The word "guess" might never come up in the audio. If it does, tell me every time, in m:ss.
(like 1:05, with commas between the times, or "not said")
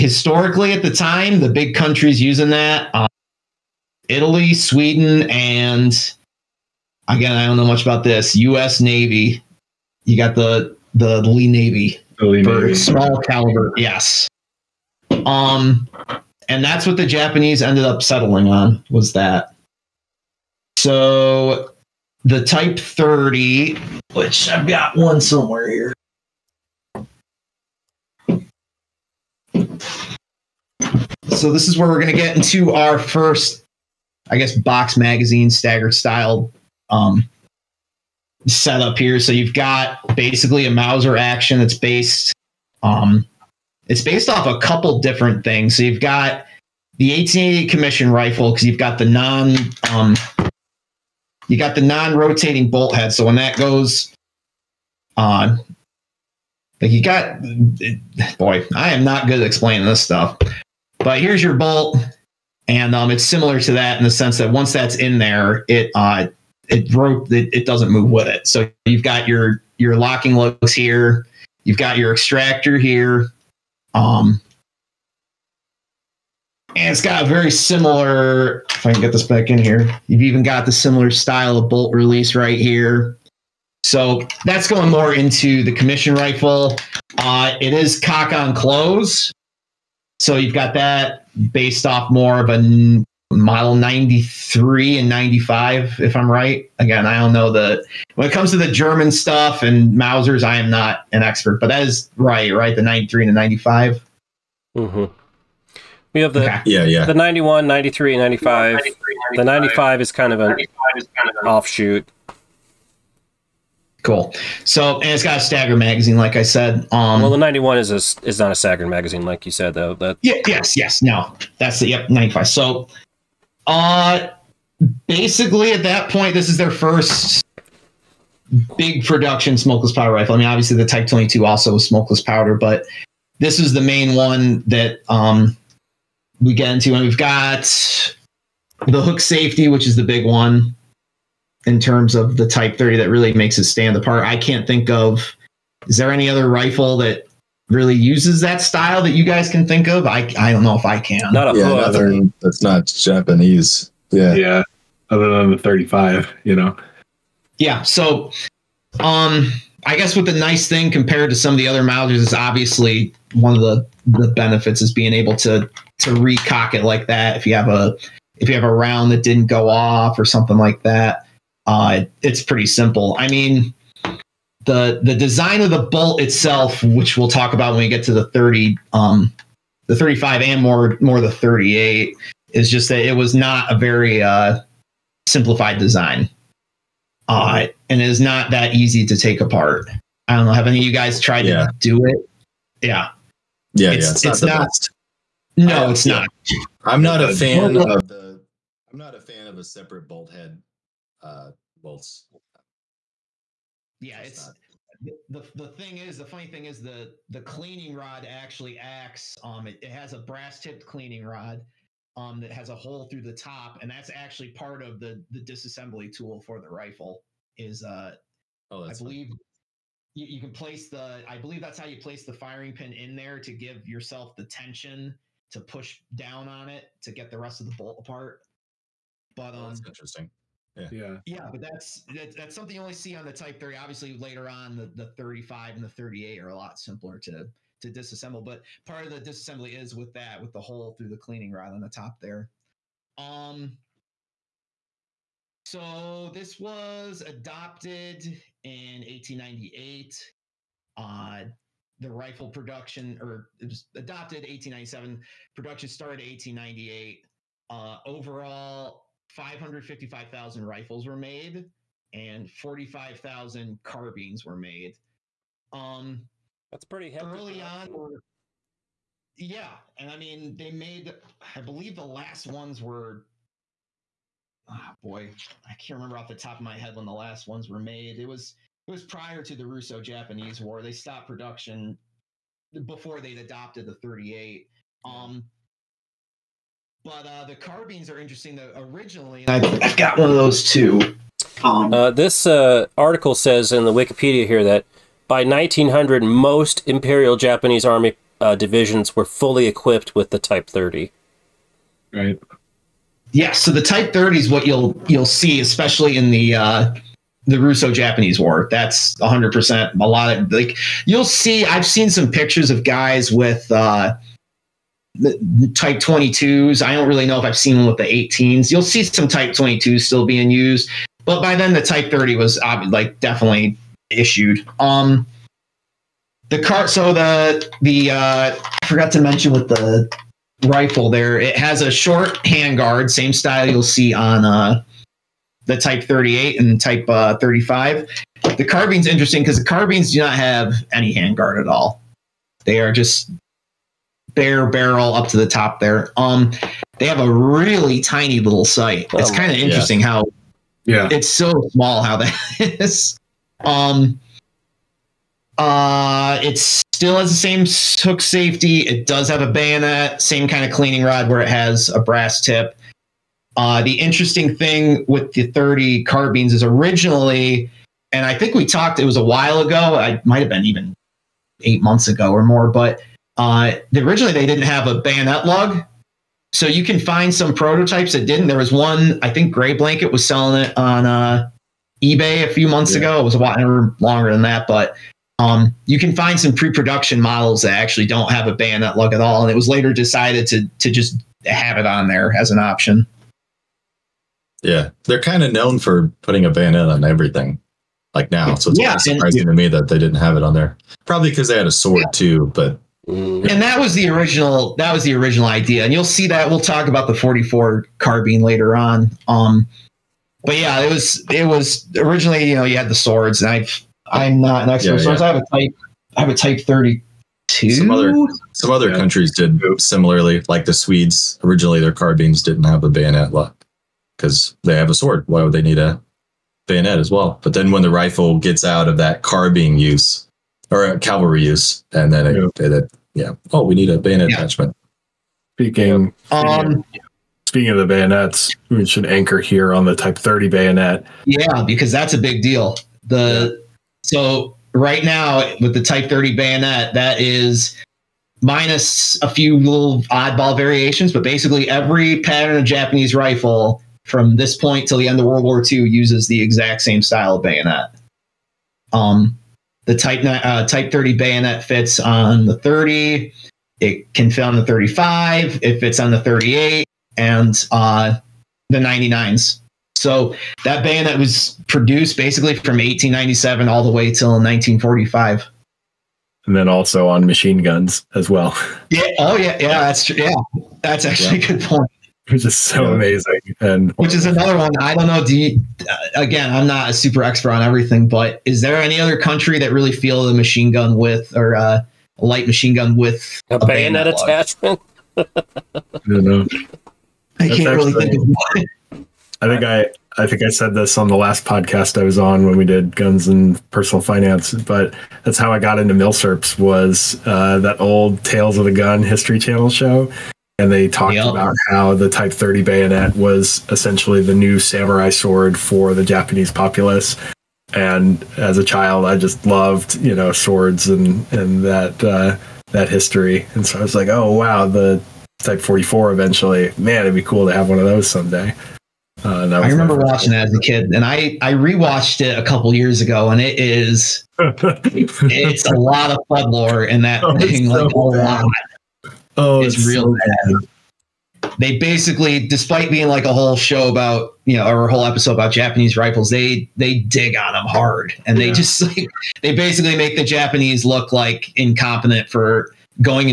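0:34, 2:39.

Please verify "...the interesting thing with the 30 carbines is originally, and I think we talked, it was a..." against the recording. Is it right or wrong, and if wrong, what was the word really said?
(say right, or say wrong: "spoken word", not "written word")
right.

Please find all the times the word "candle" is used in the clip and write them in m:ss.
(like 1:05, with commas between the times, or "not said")
not said.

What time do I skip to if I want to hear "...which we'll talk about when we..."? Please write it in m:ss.
2:56.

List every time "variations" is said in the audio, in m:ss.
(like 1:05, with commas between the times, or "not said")
7:30.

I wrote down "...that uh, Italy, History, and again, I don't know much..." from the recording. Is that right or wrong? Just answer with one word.
wrong.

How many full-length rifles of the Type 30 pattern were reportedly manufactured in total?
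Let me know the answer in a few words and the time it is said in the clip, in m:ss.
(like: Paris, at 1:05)
555,000, at 4:19.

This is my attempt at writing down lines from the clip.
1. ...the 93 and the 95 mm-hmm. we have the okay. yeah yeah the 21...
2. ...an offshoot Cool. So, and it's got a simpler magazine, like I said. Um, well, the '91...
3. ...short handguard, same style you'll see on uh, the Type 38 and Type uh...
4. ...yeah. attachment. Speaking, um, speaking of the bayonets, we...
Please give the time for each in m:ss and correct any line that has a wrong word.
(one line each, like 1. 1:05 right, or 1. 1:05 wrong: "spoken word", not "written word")
1. 1:42 wrong: "91", not "21"
2. 1:51 wrong: "stagger", not "simpler"
3. 5:31 right
4. 7:14 right.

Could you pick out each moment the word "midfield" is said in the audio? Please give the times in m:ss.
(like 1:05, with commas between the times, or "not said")
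not said.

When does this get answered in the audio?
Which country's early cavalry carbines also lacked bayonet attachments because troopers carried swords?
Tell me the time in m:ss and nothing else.
7:00.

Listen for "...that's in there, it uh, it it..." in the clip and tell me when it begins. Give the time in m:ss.
1:04.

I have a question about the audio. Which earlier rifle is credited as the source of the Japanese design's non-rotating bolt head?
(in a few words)
1880 commission rifle.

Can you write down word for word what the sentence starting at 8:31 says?
about how the Type 30 bayonet was essentially the new samurai sword for the Japanese populace.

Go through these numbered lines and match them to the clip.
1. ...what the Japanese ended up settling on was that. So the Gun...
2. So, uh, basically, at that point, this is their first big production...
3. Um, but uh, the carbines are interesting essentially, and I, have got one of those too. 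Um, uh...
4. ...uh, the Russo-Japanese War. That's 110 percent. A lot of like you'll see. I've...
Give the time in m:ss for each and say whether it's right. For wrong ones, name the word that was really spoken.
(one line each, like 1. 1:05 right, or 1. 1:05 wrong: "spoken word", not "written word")
1. 0:16 wrong: "Type", not "Gun"
2. 2:02 right
3. 4:45 wrong: "originally", not "essentially"
4. 5:06 wrong: "100", not "110".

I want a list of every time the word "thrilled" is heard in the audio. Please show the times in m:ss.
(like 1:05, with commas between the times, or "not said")
not said.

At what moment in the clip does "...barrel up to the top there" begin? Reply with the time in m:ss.
5:44.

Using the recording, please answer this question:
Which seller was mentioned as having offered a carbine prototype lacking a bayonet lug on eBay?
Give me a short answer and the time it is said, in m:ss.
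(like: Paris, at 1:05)
Gray Blanket, at 6:19.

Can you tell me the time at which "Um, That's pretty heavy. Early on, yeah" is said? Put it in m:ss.
4:25.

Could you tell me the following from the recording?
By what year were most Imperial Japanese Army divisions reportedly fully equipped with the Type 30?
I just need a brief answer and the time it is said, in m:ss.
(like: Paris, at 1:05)
1900, at 4:55.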